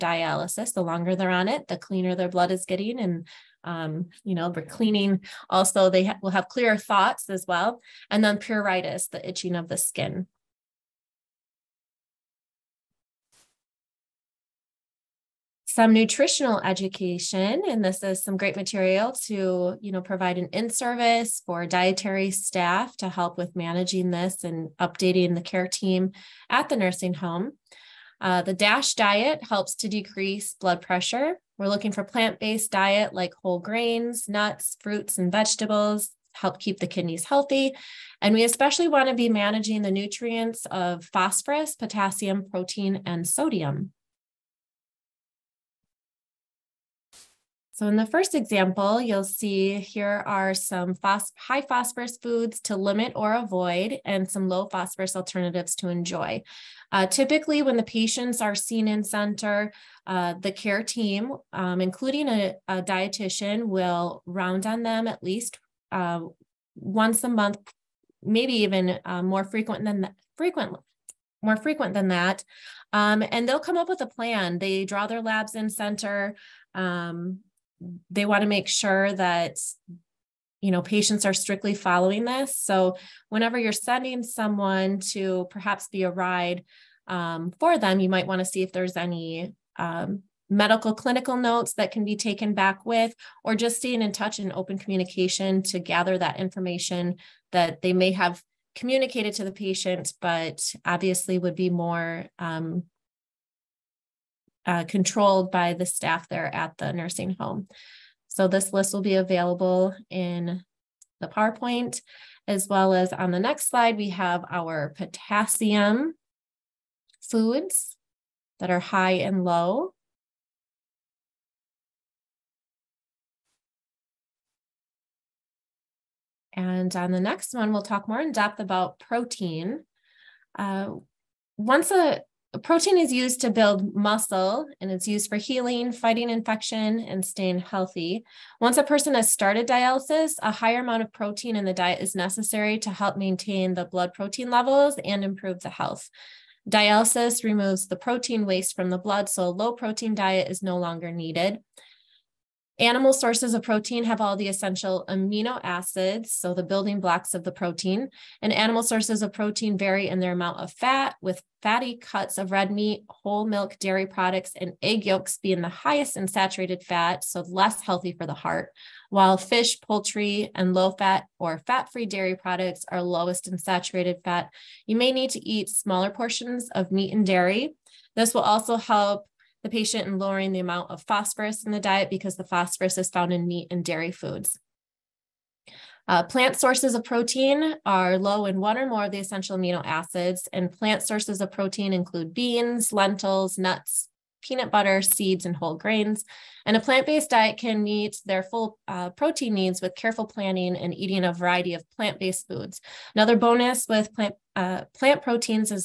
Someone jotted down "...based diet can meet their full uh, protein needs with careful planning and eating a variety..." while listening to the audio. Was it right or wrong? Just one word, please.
right.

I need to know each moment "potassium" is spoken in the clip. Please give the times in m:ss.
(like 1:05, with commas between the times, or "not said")
0:41, 1:54.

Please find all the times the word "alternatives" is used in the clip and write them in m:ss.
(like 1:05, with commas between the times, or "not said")
0:55.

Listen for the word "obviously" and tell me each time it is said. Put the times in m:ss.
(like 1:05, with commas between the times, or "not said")
1:40.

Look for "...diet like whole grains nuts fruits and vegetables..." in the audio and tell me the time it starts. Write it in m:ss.
0:32.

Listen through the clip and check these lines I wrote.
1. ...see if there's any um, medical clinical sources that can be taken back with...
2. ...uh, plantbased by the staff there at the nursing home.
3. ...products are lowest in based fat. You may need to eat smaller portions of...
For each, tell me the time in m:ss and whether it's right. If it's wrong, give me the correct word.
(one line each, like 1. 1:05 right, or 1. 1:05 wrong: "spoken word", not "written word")
1. 1:28 wrong: "notes", not "sources"
2. 1:44 wrong: "controlled", not "plantbased"
3. 2:52 wrong: "saturated", not "based".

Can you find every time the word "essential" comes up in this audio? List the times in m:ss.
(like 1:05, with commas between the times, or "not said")
2:34, 3:09.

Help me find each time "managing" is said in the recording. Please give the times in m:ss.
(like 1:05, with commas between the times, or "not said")
0:23, 0:39.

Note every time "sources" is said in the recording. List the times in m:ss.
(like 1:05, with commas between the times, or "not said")
2:33, 2:38, 3:06, 3:11.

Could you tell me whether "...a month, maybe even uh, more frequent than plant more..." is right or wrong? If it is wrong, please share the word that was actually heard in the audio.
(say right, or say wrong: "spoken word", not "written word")
wrong: "frequent", not "plant".